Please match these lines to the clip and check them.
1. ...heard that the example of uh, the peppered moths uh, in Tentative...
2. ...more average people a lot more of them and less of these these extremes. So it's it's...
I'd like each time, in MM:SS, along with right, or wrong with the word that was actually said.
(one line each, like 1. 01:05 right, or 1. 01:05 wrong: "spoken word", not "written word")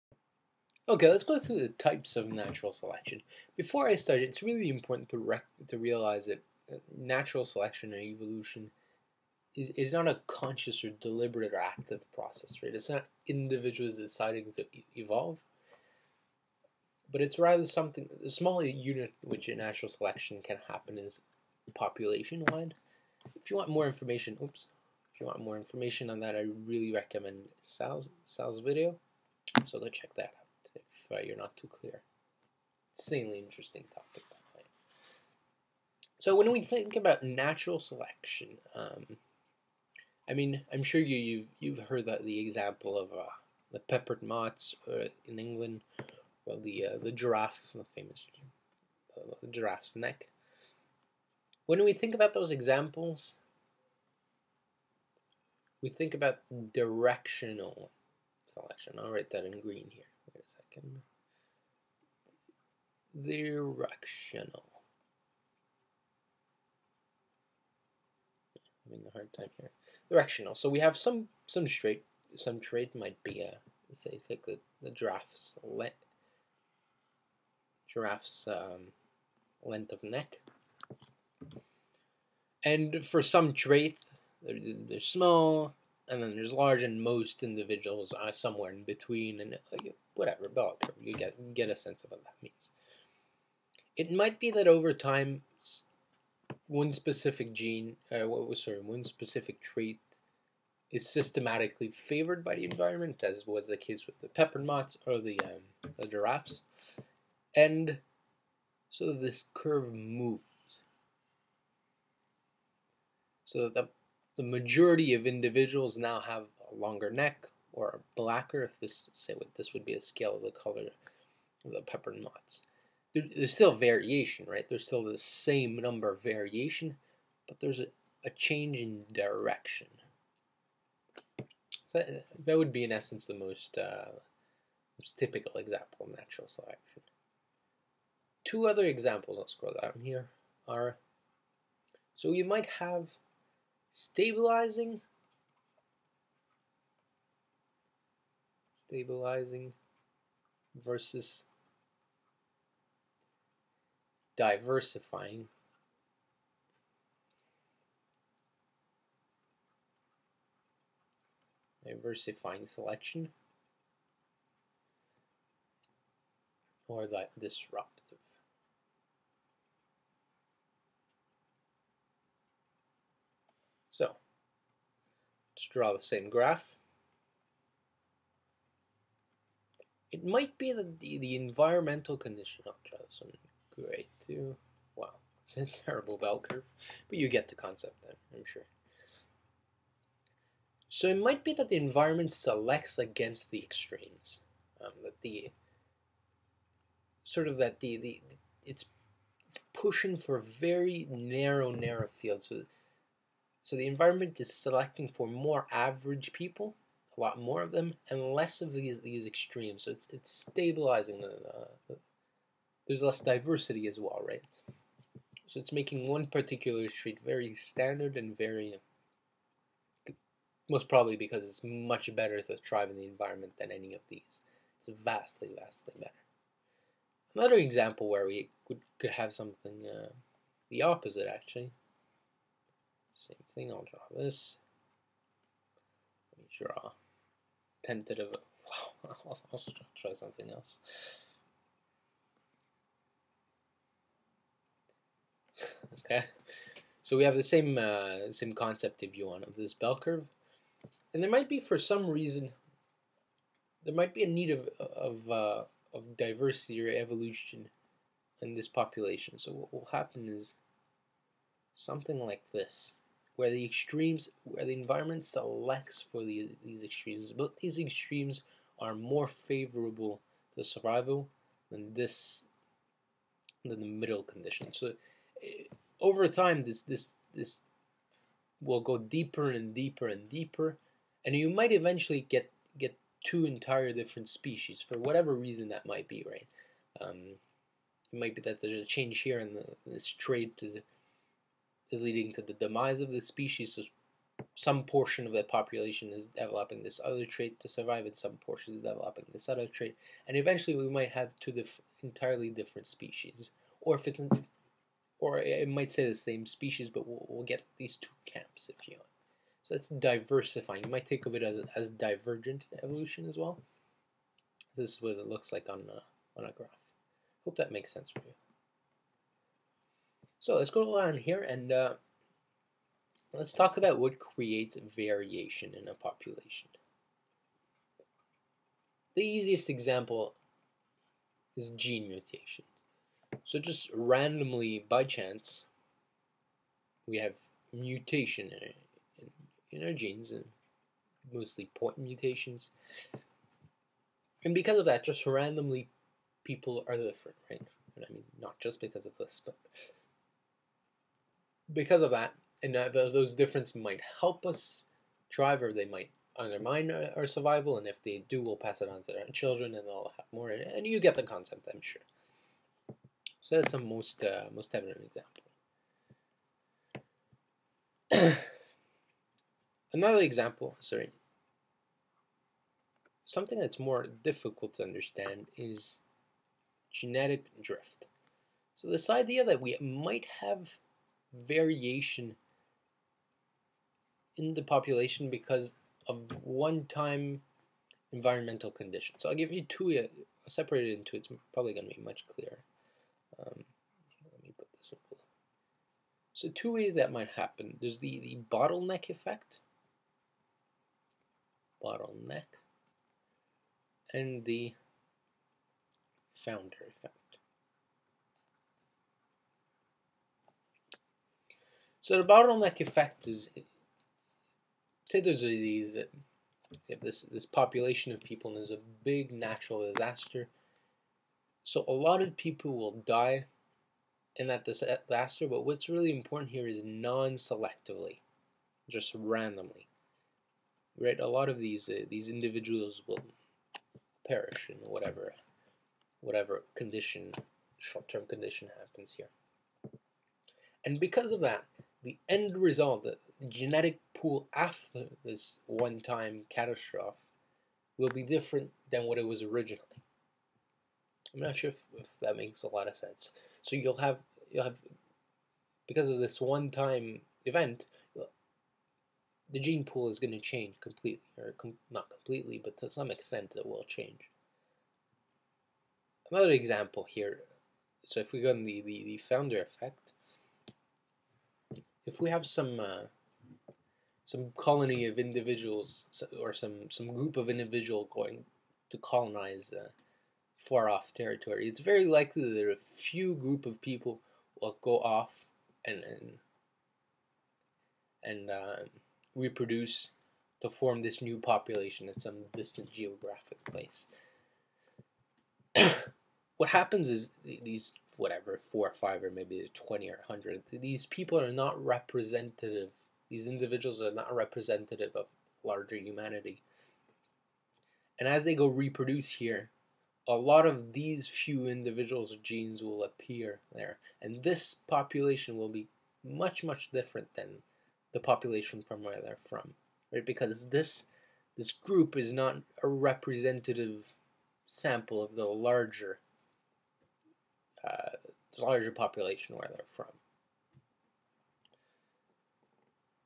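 1. 00:41 wrong: "England", not "Tentative"
2. 03:25 right.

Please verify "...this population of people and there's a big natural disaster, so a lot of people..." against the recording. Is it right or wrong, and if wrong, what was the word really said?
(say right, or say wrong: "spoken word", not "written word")
right.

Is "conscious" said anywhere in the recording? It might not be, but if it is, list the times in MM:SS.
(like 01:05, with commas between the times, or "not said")
00:10.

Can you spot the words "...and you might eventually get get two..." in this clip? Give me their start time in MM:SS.
04:41.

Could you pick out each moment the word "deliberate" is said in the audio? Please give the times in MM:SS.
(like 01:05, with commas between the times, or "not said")
00:10.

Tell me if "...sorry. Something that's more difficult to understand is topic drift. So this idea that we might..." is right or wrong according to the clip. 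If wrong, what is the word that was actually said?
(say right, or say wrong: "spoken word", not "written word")
wrong: "genetic", not "topic".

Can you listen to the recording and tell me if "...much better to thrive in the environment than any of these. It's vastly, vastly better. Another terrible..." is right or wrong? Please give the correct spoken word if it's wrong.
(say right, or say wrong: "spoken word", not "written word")
wrong: "example", not "terrible".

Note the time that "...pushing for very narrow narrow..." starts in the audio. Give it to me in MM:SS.
03:19.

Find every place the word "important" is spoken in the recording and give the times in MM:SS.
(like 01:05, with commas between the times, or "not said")
00:04, 07:06.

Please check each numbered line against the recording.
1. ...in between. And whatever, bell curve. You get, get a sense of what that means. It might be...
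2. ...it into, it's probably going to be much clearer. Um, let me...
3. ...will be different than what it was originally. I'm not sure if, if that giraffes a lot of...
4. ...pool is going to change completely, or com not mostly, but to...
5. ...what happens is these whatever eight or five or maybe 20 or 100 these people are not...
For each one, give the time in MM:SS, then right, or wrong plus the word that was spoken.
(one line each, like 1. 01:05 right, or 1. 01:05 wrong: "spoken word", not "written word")
1. 01:28 right
2. 06:30 right
3. 07:27 wrong: "makes", not "giraffes"
4. 07:39 wrong: "completely", not "mostly"
5. 08:16 wrong: "four", not "eight".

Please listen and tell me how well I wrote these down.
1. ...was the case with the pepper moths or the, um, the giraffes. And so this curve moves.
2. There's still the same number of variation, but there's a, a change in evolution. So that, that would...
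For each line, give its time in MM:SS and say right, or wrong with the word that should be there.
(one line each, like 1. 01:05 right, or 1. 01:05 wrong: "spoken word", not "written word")
1. 01:43 right
2. 02:04 wrong: "direction", not "evolution".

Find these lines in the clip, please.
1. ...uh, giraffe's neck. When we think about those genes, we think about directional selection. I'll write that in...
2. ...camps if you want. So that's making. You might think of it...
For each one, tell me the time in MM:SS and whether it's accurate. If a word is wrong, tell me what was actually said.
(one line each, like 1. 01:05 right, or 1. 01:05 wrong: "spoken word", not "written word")
1. 00:49 wrong: "examples", not "genes"
2. 05:08 wrong: "diversifying", not "making".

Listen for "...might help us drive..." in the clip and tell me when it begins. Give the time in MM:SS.
05:53.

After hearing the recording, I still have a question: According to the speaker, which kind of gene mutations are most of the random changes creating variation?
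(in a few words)
point mutations.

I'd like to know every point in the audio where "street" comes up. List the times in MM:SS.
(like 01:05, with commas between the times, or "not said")
03:36.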